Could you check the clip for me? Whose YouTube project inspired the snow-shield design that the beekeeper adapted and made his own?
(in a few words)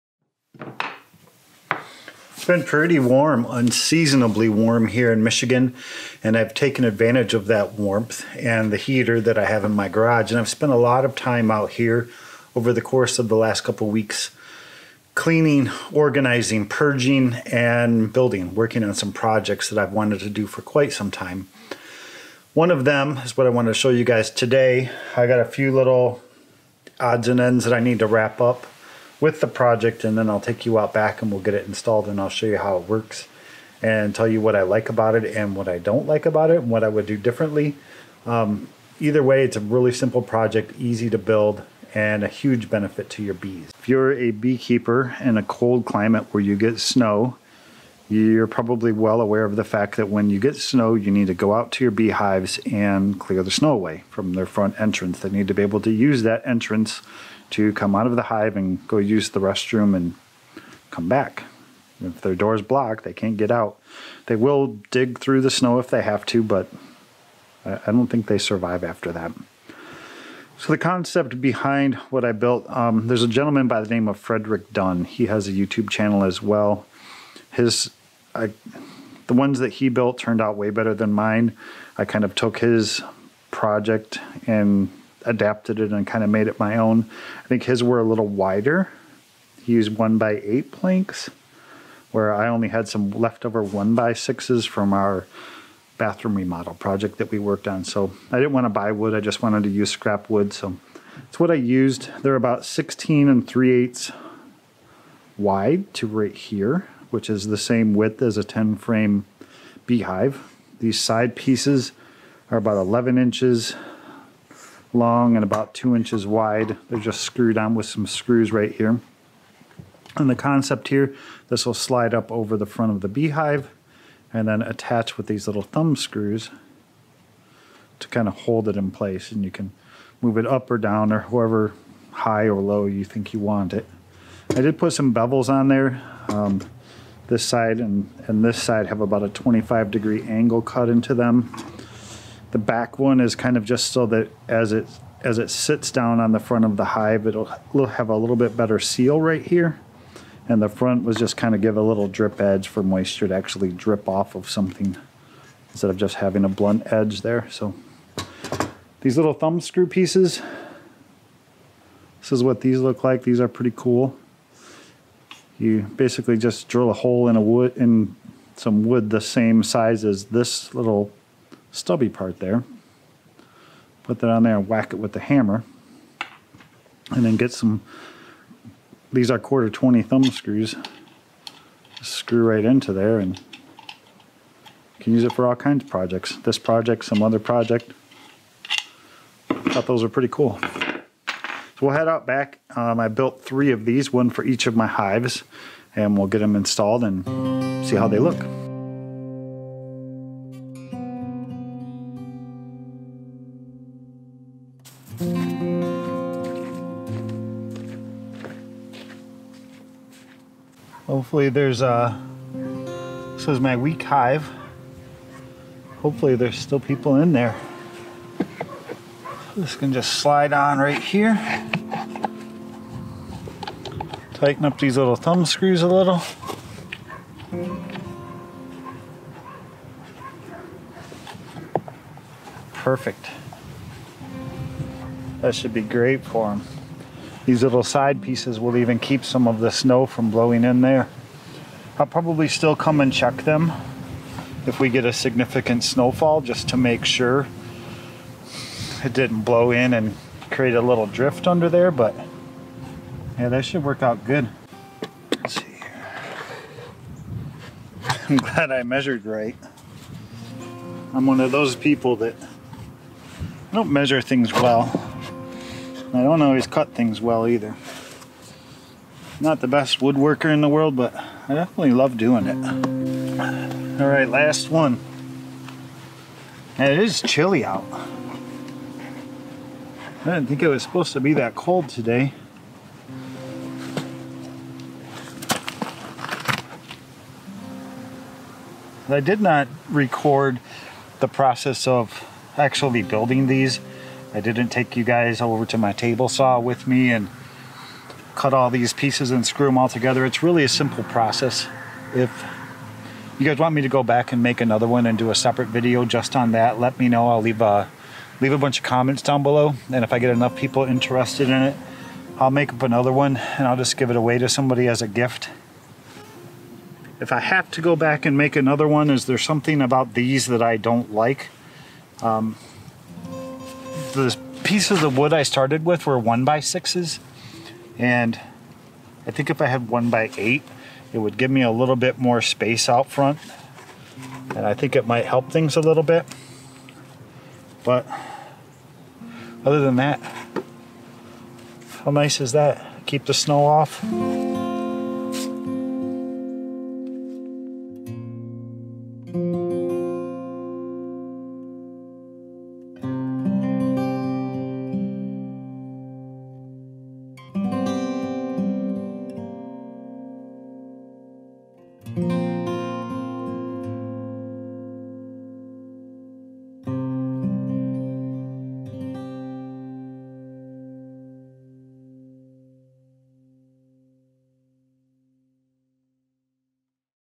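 Frederick Dunn.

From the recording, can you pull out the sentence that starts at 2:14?
I did put some bevels on there.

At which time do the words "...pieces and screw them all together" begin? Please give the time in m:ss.
4:58.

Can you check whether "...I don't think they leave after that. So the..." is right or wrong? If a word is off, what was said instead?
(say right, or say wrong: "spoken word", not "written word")
wrong: "survive", not "leave".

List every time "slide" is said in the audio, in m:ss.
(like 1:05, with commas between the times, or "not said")
2:01, 3:40.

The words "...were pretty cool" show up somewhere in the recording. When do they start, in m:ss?
3:10.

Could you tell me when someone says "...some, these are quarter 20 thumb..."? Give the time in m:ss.
2:57.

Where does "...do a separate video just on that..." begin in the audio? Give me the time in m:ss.
5:05.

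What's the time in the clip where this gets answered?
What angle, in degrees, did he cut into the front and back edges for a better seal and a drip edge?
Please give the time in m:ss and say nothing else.
2:19.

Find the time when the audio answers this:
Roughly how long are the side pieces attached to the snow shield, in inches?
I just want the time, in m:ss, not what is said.
1:52.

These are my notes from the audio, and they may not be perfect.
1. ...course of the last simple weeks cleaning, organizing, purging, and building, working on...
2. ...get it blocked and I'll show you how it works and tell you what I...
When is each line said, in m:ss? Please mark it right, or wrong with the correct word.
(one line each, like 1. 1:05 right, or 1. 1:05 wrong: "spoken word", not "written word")
1. 0:12 wrong: "couple", not "simple"
2. 0:31 wrong: "installed", not "blocked".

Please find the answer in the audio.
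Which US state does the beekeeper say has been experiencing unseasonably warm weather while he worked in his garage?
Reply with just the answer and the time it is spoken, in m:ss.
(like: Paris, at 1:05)
Michigan, at 0:05.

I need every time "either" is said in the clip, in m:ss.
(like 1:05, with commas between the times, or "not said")
0:38, 4:27.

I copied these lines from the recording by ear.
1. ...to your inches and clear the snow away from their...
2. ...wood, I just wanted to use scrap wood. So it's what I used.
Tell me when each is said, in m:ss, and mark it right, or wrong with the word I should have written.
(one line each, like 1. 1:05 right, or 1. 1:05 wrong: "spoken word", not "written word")
1. 0:51 wrong: "beehives", not "inches"
2. 1:38 right.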